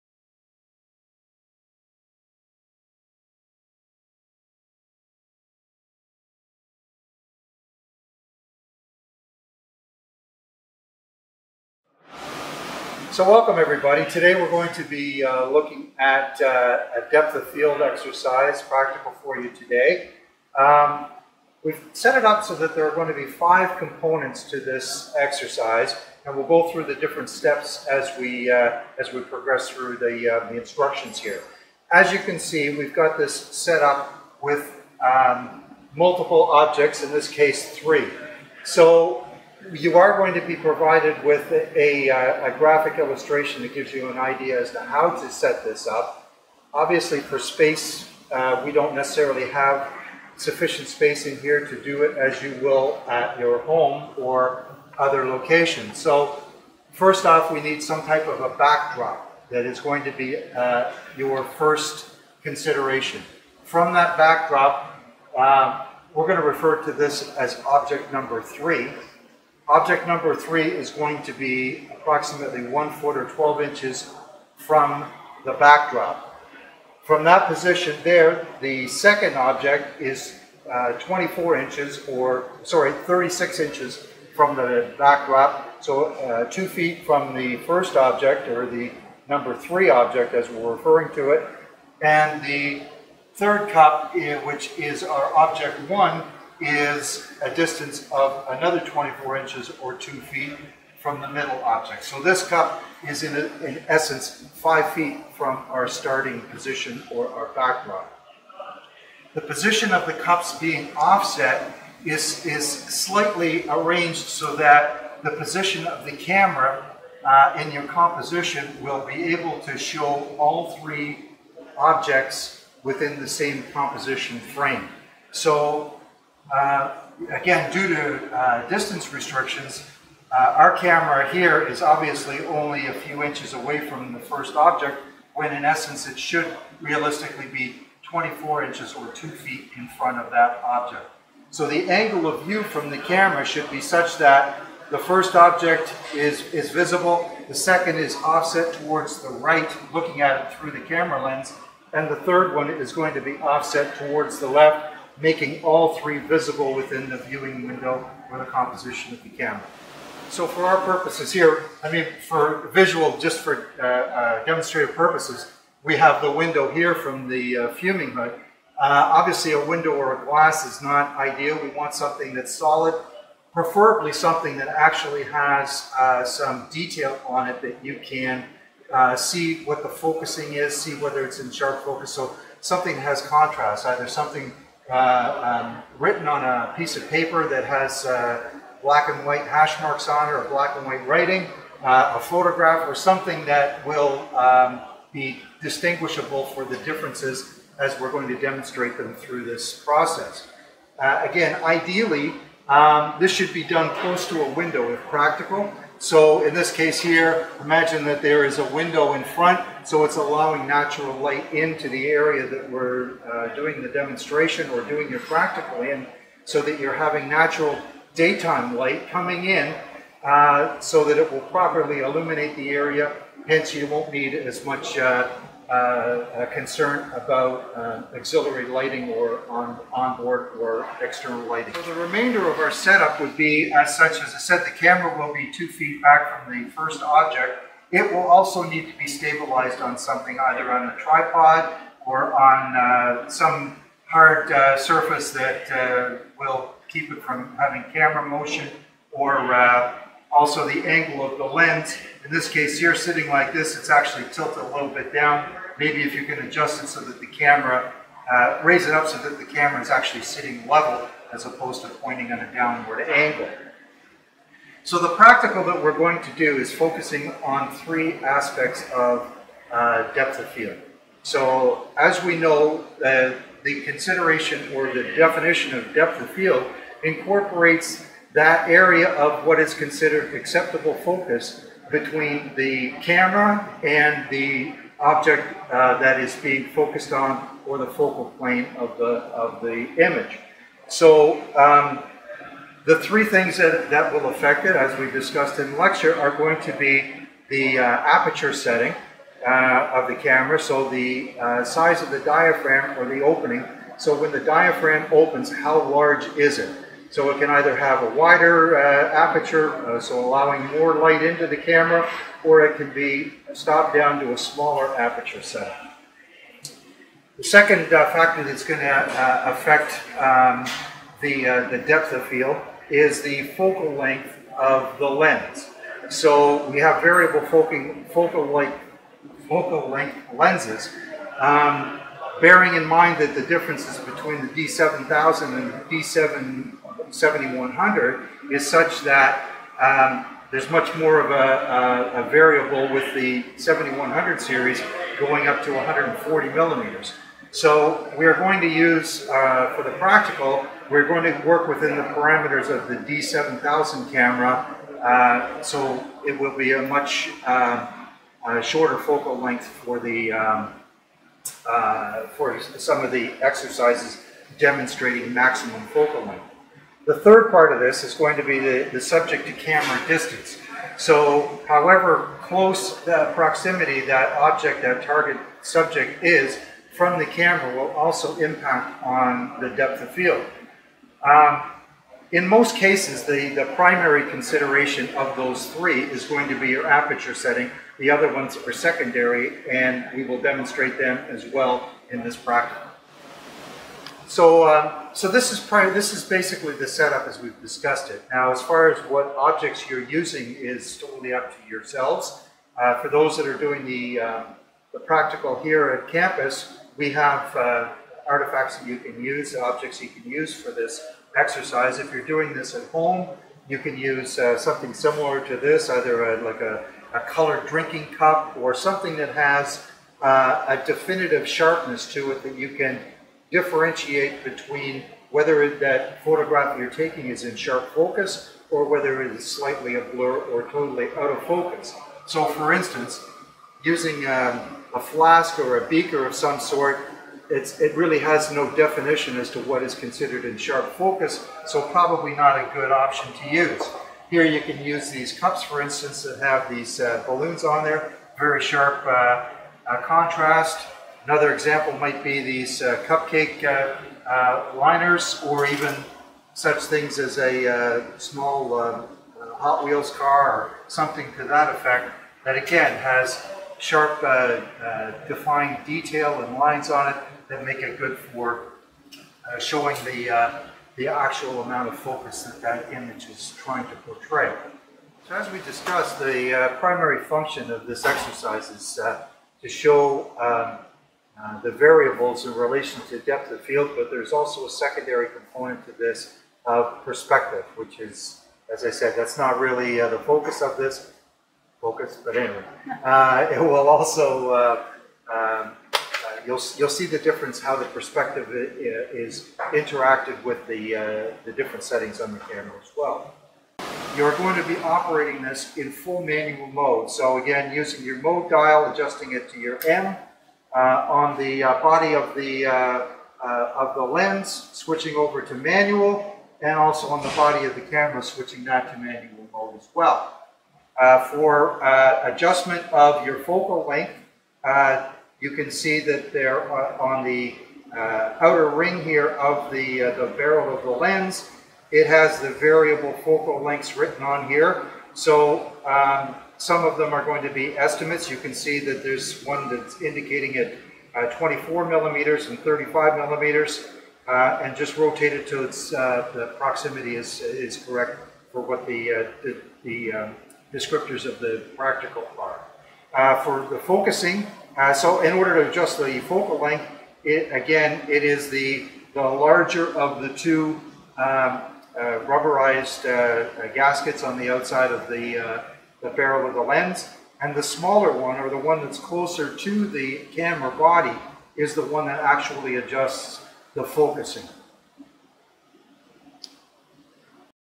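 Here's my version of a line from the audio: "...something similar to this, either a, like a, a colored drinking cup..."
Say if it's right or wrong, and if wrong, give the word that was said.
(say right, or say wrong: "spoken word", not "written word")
right.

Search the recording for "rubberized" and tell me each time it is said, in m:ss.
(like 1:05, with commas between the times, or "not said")
9:22.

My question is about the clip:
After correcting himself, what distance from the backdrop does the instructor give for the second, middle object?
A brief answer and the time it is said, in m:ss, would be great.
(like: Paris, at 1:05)
36 inches, at 1:22.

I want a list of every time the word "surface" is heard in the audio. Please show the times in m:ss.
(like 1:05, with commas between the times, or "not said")
4:04.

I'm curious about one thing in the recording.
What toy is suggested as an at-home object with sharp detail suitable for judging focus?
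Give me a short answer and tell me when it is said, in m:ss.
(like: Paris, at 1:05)
Hot Wheels car, at 7:39.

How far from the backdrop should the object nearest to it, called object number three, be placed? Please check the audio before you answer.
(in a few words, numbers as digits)
12 inches.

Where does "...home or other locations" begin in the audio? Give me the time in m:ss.
0:53.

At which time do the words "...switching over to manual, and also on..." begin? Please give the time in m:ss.
8:34.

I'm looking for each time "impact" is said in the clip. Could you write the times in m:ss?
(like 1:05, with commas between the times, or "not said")
6:18.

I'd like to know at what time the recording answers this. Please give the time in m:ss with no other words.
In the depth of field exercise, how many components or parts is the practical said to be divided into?
0:23.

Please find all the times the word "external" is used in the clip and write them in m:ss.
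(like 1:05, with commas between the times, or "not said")
3:51.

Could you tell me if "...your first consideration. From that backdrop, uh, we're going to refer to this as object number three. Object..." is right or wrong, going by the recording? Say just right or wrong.
right.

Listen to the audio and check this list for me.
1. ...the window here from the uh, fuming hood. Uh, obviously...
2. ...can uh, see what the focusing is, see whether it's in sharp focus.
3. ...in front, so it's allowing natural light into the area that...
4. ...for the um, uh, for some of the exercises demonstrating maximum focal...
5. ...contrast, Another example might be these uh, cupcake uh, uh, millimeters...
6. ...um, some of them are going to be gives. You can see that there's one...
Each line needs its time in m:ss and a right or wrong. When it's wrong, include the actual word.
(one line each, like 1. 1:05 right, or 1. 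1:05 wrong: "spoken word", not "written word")
1. 2:46 right
2. 2:58 right
3. 3:29 right
4. 5:59 right
5. 7:30 wrong: "liners", not "millimeters"
6. 8:55 wrong: "estimates", not "gives".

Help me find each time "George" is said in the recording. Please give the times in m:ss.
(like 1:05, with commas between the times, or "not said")
not said.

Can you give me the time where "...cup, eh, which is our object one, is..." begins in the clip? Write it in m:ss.
1:33.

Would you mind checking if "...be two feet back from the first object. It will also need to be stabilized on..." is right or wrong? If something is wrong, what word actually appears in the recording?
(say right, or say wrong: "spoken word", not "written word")
right.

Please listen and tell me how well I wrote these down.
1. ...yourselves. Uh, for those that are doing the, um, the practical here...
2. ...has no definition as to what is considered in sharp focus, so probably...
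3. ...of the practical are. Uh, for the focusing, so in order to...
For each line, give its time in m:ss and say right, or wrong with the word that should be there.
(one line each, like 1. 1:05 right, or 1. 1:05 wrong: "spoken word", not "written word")
1. 6:41 right
2. 7:18 right
3. 9:11 right.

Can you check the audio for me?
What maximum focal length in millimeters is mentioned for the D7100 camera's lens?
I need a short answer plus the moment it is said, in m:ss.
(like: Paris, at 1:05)
140 millimeters, at 5:45.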